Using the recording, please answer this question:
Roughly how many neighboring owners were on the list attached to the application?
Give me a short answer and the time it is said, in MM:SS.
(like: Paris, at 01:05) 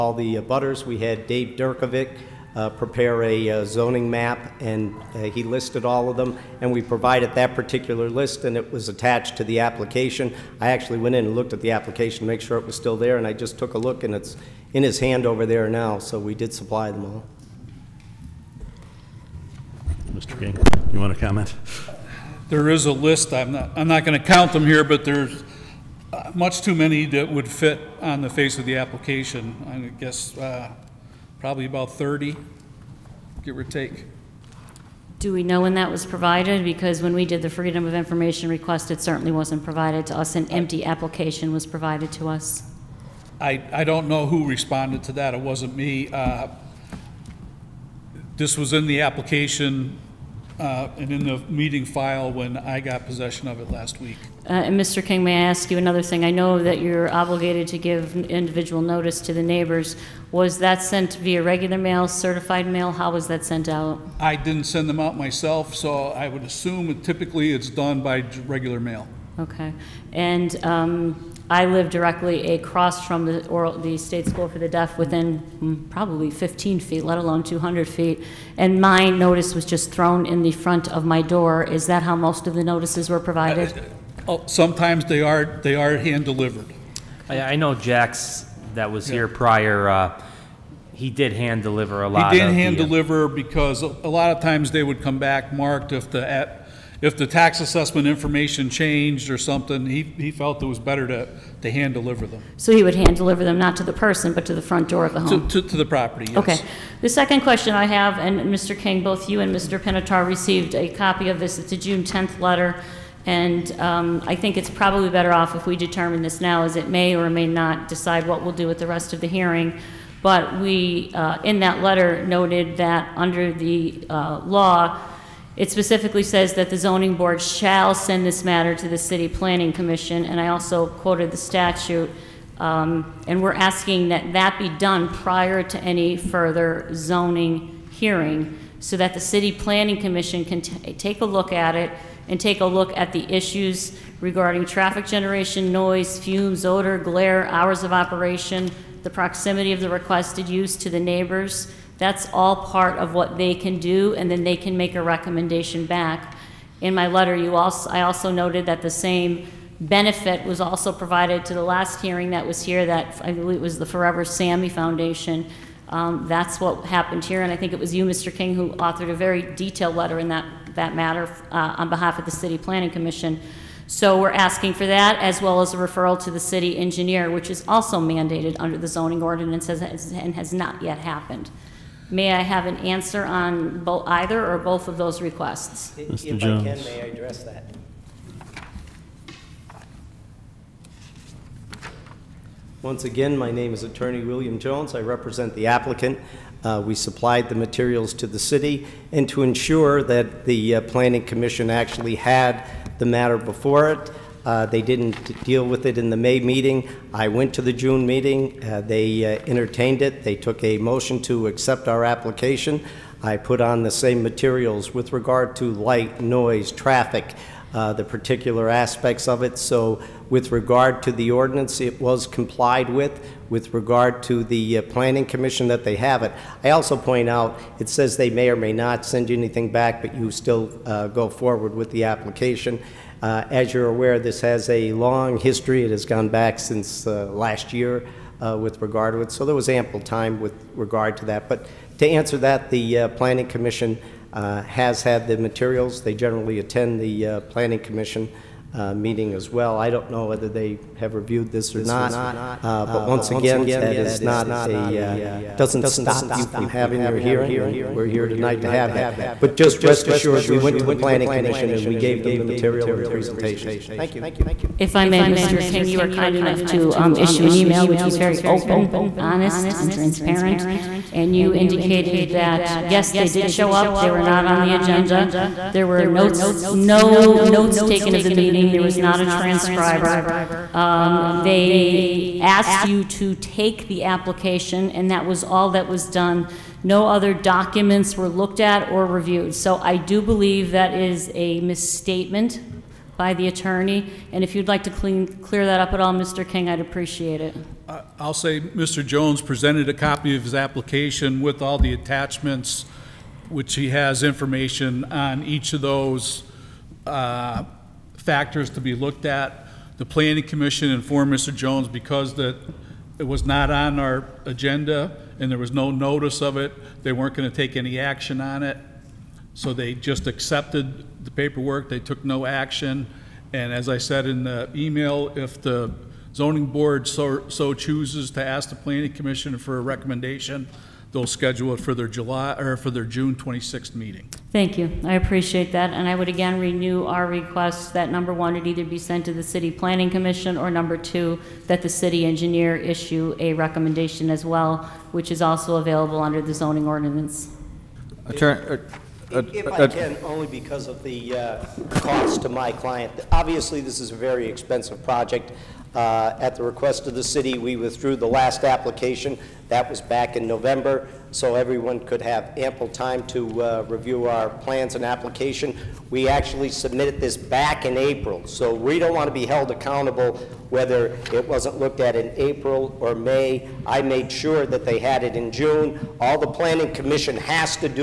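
30, at 00:31.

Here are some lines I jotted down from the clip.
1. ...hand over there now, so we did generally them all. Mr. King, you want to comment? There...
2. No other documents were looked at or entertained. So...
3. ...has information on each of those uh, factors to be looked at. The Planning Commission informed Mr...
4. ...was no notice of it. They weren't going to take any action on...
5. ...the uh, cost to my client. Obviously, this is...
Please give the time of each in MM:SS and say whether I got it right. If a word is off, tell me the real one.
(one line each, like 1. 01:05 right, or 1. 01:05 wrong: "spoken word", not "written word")
1. 00:14 wrong: "supply", not "generally"
2. 04:46 wrong: "reviewed", not "entertained"
3. 05:03 right
4. 05:15 right
5. 05:51 right.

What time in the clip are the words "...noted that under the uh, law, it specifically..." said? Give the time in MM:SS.
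02:02.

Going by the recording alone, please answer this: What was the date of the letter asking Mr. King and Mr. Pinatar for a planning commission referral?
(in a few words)
June 10.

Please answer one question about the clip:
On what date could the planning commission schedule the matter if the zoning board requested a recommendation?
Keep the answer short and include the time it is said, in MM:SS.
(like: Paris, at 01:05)
June 26, at 05:33.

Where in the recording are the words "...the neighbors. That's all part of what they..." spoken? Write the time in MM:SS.
02:30.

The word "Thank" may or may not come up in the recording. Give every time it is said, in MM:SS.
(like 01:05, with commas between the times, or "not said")
04:23, 05:34.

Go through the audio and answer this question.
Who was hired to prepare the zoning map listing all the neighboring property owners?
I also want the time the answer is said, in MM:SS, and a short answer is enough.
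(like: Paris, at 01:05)
Dave Durkovic, at 00:01.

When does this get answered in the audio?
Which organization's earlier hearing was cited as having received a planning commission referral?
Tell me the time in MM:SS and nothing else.
02:43.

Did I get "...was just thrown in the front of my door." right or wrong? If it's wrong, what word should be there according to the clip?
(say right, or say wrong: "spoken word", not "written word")
right.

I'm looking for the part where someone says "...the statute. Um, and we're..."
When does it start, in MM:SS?
02:11.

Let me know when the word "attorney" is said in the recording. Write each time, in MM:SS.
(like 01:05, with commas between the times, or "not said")
03:13, 04:53, 05:48.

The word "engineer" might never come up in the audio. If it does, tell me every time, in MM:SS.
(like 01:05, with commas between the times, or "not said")
02:56, 05:42.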